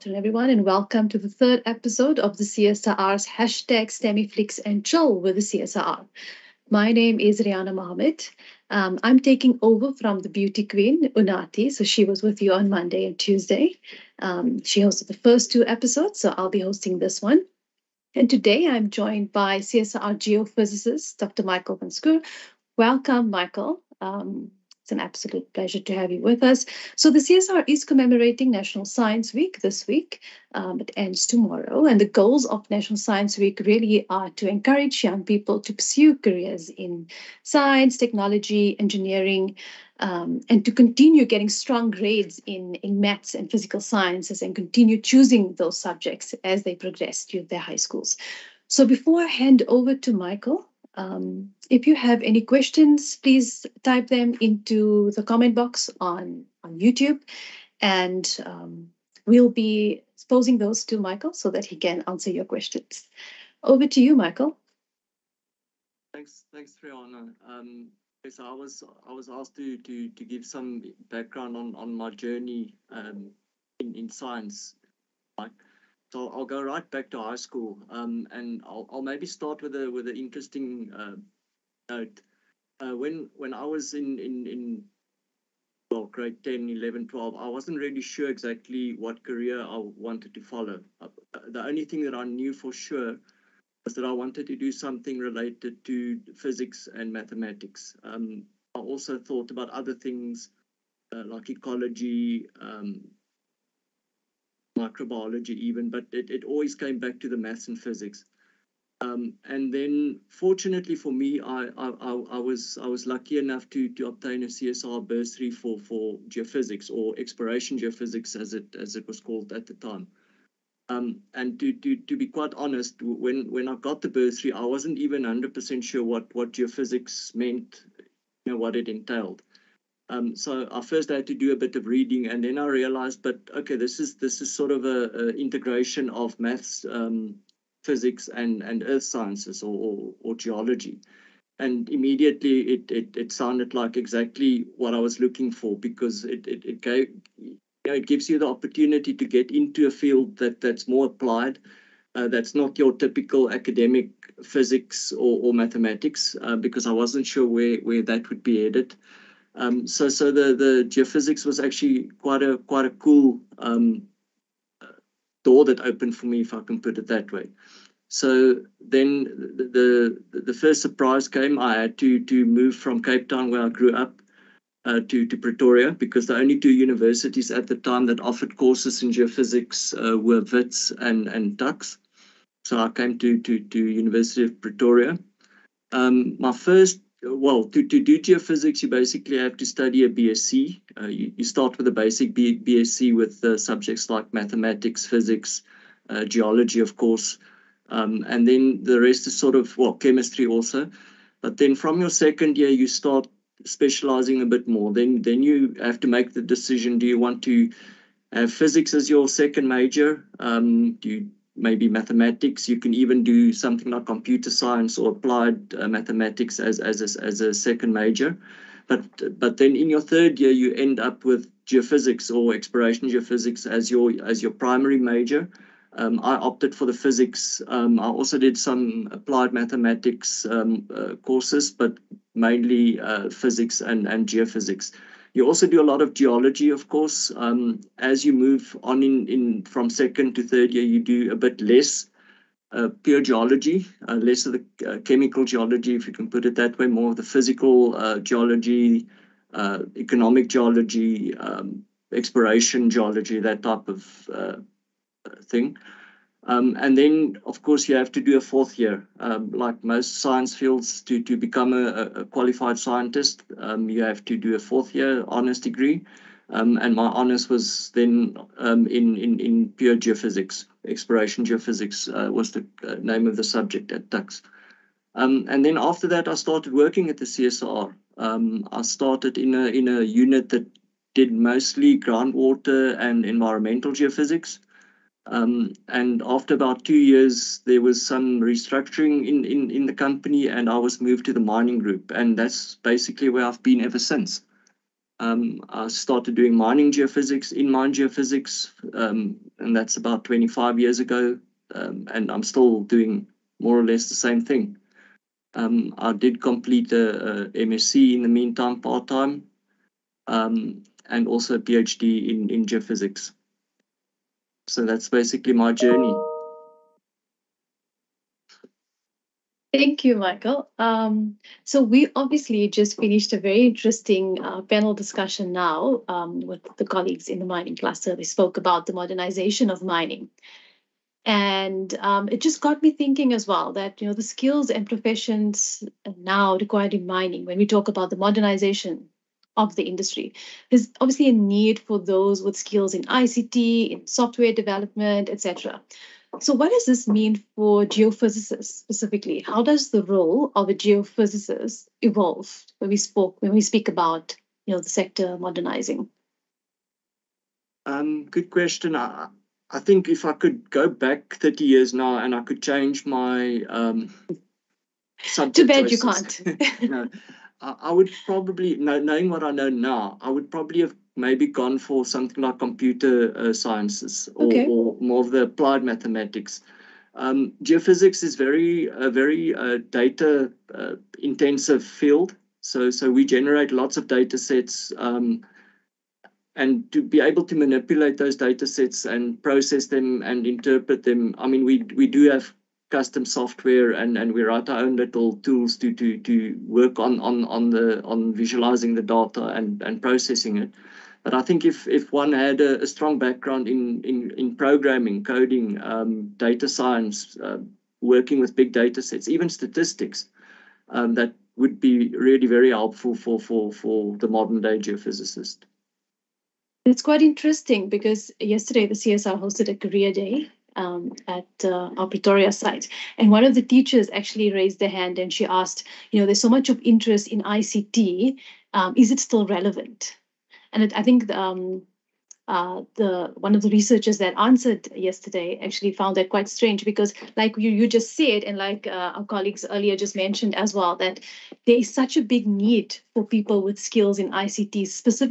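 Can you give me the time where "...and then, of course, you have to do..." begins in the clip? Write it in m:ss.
4:16.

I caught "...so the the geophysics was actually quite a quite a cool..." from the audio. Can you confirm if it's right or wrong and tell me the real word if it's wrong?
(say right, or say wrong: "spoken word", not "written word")
right.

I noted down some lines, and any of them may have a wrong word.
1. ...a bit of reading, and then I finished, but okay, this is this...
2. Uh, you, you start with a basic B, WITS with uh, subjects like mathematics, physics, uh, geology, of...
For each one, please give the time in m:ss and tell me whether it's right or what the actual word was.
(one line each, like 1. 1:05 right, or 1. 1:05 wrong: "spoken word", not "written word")
1. 2:11 wrong: "realized", not "finished"
2. 3:10 wrong: "BSc", not "WITS".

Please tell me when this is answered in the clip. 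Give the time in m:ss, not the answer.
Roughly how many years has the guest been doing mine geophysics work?
5:00.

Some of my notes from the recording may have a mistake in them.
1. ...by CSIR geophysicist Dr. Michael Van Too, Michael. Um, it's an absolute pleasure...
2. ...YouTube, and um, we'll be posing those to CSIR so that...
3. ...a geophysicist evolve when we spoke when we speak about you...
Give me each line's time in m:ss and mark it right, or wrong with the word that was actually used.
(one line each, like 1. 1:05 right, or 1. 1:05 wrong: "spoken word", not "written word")
1. 0:19 wrong: "Welcome", not "Too"
2. 0:56 wrong: "Michael", not "CSIR"
3. 5:50 right.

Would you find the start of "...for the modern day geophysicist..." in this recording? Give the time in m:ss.
6:53.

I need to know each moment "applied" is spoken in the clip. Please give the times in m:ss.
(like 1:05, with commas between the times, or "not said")
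2:31, 3:35, 3:49, 6:15.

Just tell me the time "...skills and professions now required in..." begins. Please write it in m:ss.
5:34.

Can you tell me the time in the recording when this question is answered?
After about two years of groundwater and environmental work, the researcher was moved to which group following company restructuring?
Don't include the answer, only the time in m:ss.
4:51.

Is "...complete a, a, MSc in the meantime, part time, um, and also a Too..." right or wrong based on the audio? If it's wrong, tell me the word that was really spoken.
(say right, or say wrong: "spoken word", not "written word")
wrong: "PhD", not "Too".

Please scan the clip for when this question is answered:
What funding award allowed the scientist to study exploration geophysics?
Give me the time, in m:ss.
1:54.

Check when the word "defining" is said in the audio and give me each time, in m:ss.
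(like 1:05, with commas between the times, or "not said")
not said.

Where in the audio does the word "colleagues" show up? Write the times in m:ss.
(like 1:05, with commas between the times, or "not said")
5:26, 7:19.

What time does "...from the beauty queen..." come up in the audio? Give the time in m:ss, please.
0:09.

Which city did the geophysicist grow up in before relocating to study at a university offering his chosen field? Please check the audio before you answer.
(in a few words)
Cape Town.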